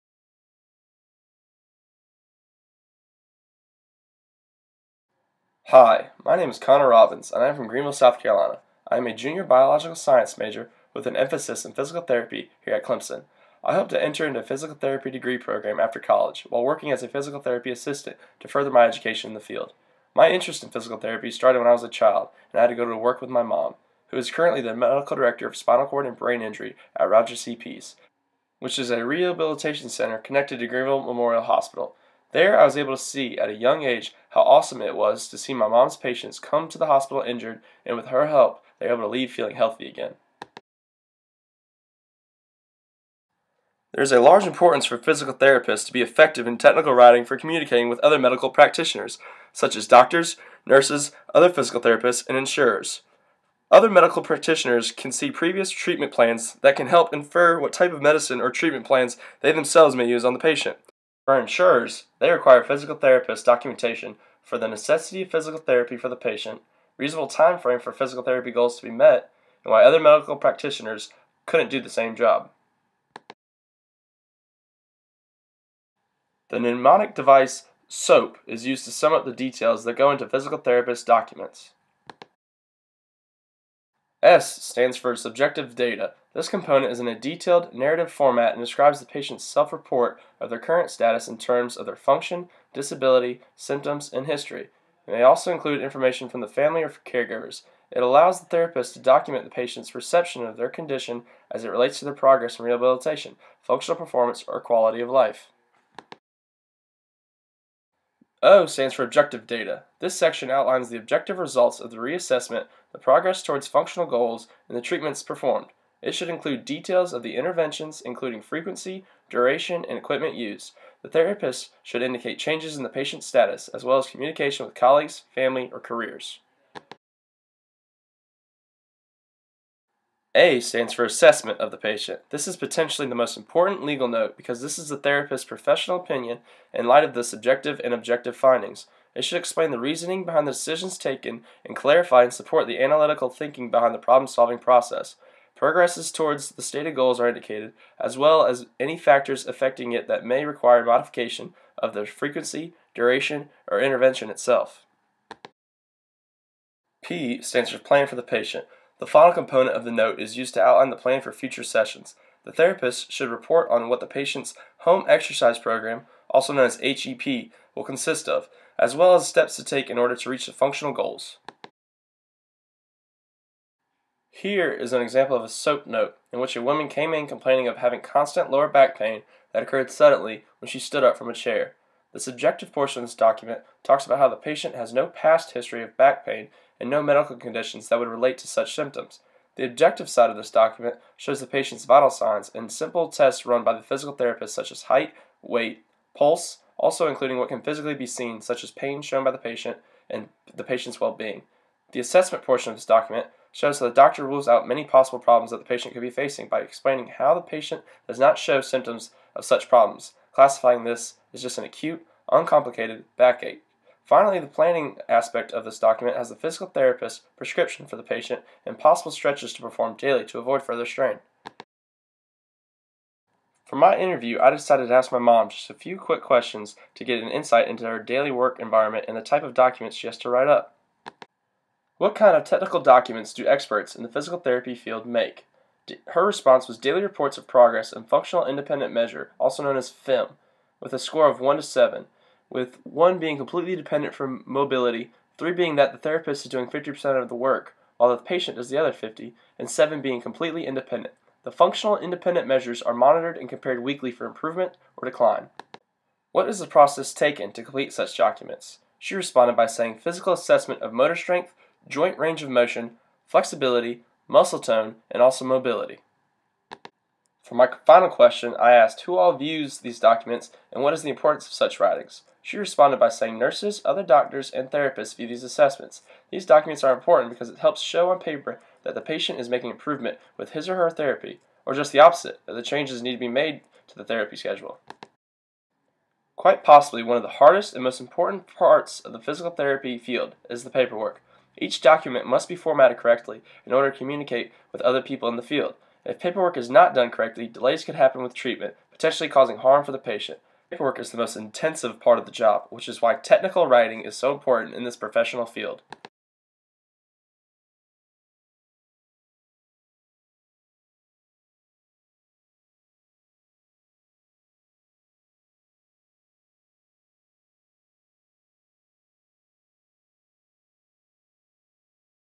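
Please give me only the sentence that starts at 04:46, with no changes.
Quite possibly one of the hardest and most important parts of the physical therapy field is the paperwork.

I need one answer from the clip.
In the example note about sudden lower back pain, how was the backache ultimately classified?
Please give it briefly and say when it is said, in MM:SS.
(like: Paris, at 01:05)
Acute, uncomplicated backache, at 03:31.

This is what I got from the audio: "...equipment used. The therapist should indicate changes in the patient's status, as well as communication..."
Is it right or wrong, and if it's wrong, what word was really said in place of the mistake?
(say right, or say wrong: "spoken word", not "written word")
right.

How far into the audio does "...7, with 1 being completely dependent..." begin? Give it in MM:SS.
04:01.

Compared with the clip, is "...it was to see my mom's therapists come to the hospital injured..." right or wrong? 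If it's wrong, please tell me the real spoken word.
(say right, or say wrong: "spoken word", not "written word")
wrong: "patients", not "therapists".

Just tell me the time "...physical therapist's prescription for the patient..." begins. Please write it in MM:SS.
03:36.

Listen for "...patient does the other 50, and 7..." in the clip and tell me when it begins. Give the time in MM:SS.
04:08.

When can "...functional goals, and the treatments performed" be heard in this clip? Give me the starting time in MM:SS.
01:53.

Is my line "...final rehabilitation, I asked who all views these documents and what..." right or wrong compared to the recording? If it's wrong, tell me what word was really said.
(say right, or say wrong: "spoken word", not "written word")
wrong: "question", not "rehabilitation".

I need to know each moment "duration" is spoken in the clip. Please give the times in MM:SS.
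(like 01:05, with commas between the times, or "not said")
01:59, 02:32.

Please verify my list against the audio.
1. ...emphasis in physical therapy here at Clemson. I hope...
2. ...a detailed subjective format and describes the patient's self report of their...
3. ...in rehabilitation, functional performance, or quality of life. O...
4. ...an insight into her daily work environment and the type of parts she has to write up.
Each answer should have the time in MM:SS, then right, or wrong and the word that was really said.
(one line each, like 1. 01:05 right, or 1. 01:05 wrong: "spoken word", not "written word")
1. 00:11 right
2. 01:27 wrong: "narrative", not "subjective"
3. 01:42 right
4. 03:47 wrong: "documents", not "parts".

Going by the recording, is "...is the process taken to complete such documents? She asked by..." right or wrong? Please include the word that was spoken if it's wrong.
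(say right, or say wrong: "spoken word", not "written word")
wrong: "responded", not "asked".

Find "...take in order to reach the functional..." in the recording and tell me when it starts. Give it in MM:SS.
02:49.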